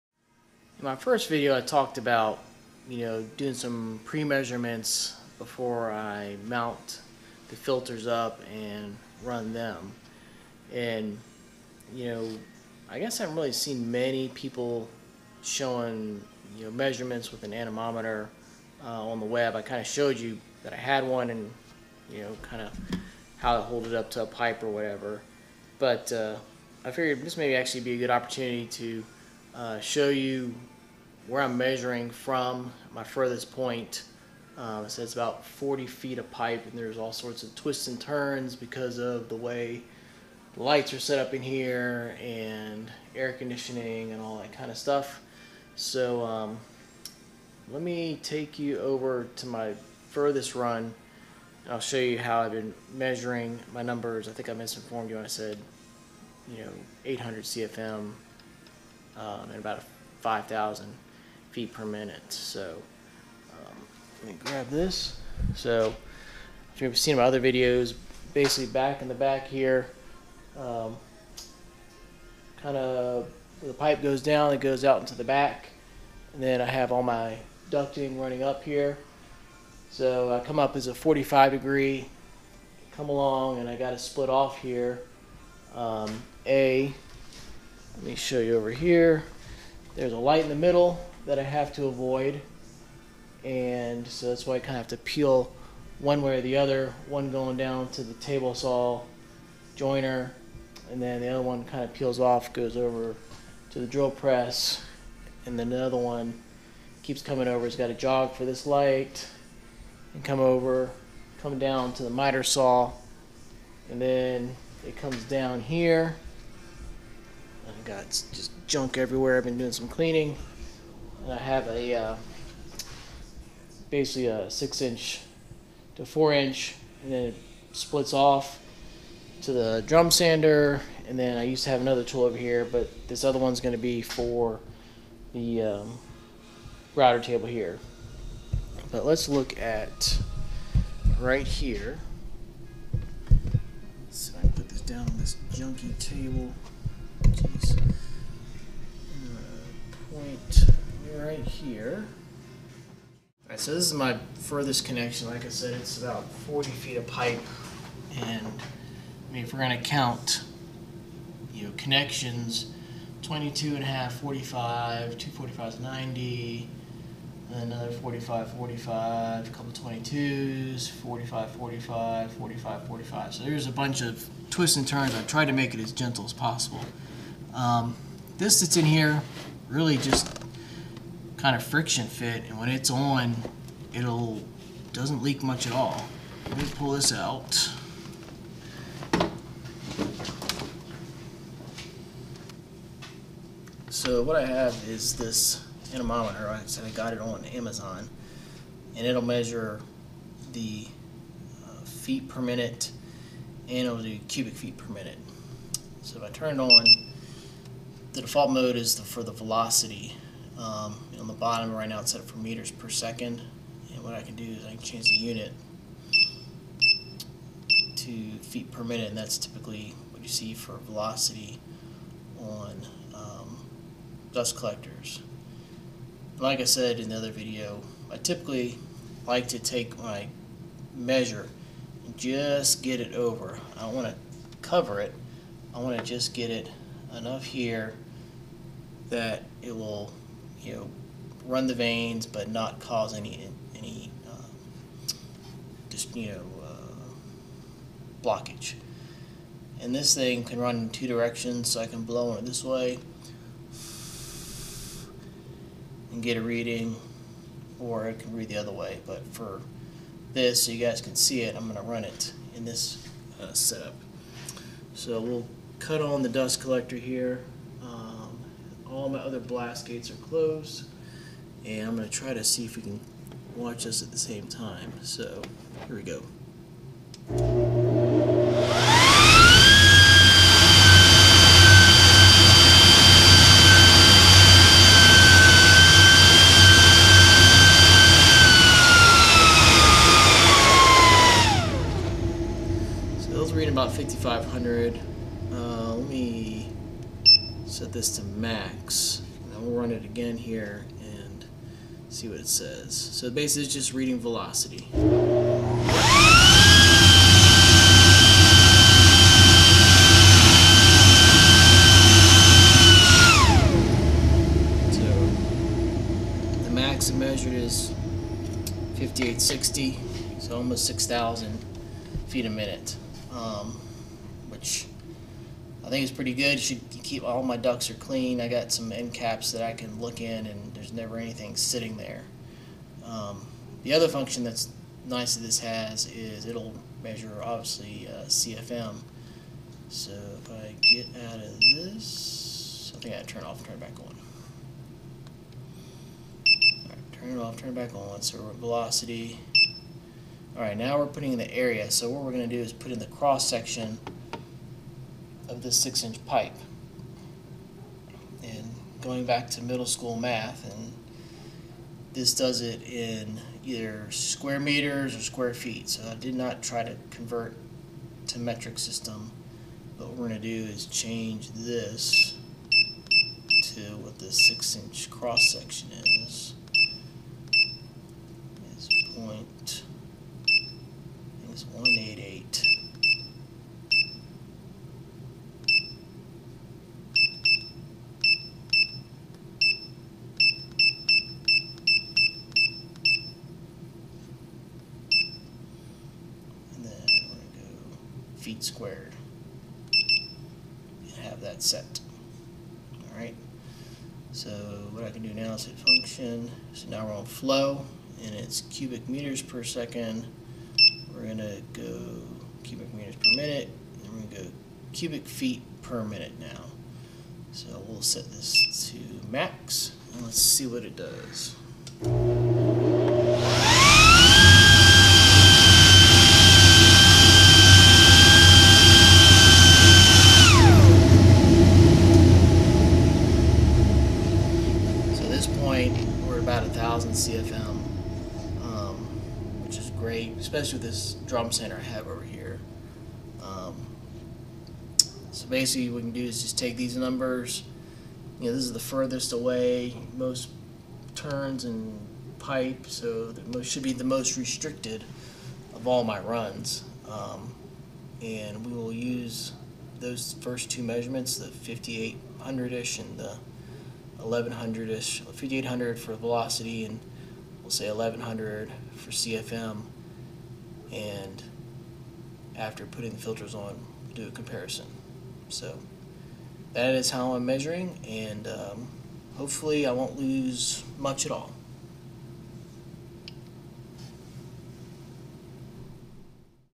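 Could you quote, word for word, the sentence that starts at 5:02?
So basically it's just reading velocity.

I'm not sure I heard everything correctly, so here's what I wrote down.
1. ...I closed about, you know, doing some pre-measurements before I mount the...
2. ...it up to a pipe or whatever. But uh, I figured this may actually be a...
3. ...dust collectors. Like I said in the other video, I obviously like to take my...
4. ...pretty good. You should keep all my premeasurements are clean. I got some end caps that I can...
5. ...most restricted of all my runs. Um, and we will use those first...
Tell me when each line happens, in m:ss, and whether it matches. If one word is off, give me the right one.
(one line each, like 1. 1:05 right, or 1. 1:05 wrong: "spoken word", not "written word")
1. 0:01 wrong: "talked", not "closed"
2. 0:23 right
3. 3:44 wrong: "typically", not "obviously"
4. 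5:26 wrong: "ducts", not "premeasurements"
5. 7:34 right.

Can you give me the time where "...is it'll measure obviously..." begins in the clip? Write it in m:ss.
5:36.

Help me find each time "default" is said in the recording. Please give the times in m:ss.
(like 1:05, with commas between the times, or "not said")
3:28.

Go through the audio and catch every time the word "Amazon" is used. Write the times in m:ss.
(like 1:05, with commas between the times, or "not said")
3:17.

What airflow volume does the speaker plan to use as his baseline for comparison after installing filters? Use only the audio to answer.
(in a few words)
1100 CFM.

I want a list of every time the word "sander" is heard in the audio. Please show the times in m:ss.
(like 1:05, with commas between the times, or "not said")
2:10, 7:21.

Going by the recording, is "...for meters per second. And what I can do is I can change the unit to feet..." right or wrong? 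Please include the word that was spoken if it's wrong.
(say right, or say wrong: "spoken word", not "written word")
right.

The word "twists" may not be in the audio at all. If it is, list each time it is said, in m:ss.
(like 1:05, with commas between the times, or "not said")
0:37, 2:54.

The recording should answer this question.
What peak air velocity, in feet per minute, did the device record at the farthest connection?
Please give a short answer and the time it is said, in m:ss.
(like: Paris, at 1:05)
5860, at 5:18.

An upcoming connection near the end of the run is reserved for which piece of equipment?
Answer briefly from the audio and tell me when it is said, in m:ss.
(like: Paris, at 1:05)
router table, at 2:16.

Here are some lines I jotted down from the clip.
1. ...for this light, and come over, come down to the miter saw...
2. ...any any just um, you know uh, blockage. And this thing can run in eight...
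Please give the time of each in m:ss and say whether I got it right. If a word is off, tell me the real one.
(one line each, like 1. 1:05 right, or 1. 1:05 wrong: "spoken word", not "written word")
1. 1:48 right
2. 4:03 wrong: "two", not "eight".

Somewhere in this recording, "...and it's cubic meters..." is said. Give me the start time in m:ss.
6:48.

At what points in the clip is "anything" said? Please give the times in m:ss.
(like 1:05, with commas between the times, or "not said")
5:31.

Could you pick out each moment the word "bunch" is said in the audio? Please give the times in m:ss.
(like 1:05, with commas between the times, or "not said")
2:53.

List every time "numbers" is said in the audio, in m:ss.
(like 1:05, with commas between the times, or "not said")
0:53, 7:26.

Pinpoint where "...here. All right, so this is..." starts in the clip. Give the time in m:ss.
2:31.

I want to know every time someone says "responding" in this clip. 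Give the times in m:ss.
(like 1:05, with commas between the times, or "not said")
not said.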